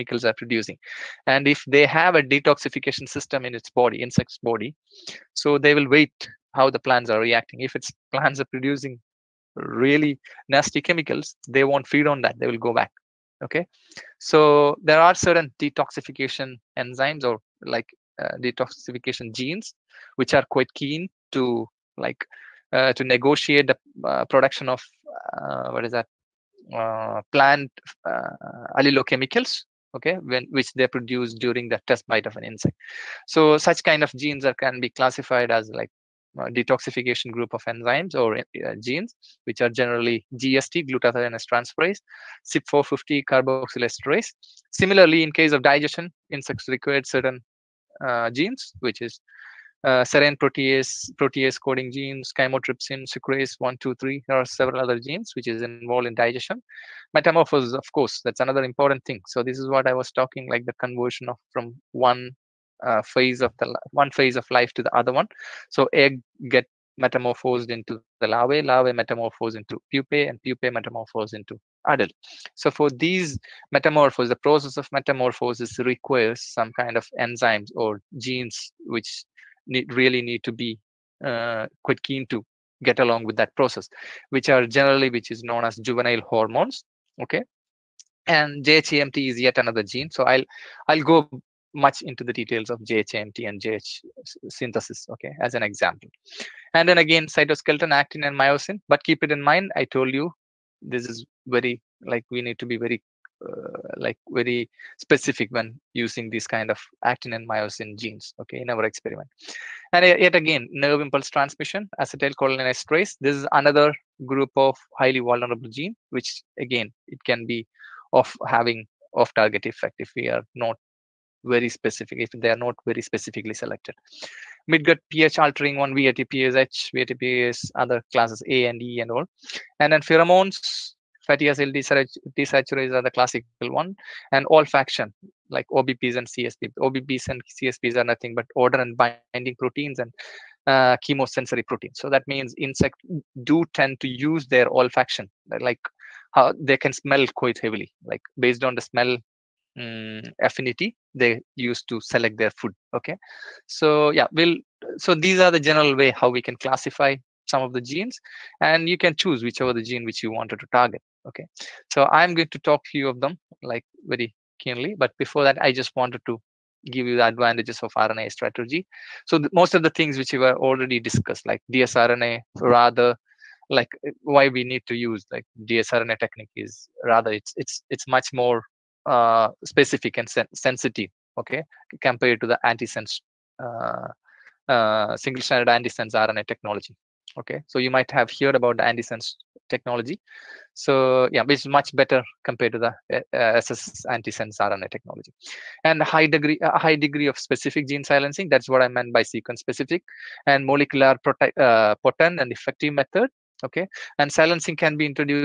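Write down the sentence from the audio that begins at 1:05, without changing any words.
So egg get metamorphosed into the larvae, larvae metamorphose into pupae, and pupae metamorphose into adult.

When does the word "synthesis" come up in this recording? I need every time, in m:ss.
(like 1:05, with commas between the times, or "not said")
1:34.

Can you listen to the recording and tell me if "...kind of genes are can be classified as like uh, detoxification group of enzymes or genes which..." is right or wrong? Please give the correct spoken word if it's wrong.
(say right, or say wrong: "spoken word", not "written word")
right.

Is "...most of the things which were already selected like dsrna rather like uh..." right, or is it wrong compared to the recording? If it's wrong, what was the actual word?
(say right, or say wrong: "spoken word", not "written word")
wrong: "discussed", not "selected".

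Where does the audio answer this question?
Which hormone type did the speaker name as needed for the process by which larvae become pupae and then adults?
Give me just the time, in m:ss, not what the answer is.
1:25.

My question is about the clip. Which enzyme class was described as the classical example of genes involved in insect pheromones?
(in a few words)
fatty acid desaturase.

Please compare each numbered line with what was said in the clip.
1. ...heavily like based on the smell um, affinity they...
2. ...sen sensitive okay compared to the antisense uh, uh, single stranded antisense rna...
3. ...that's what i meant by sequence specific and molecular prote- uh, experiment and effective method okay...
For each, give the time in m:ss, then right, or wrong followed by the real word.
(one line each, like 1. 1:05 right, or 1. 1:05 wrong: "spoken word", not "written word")
1. 2:27 right
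2. 3:00 right
3. 3:18 wrong: "potent", not "experiment".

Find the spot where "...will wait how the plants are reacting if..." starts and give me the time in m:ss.
0:05.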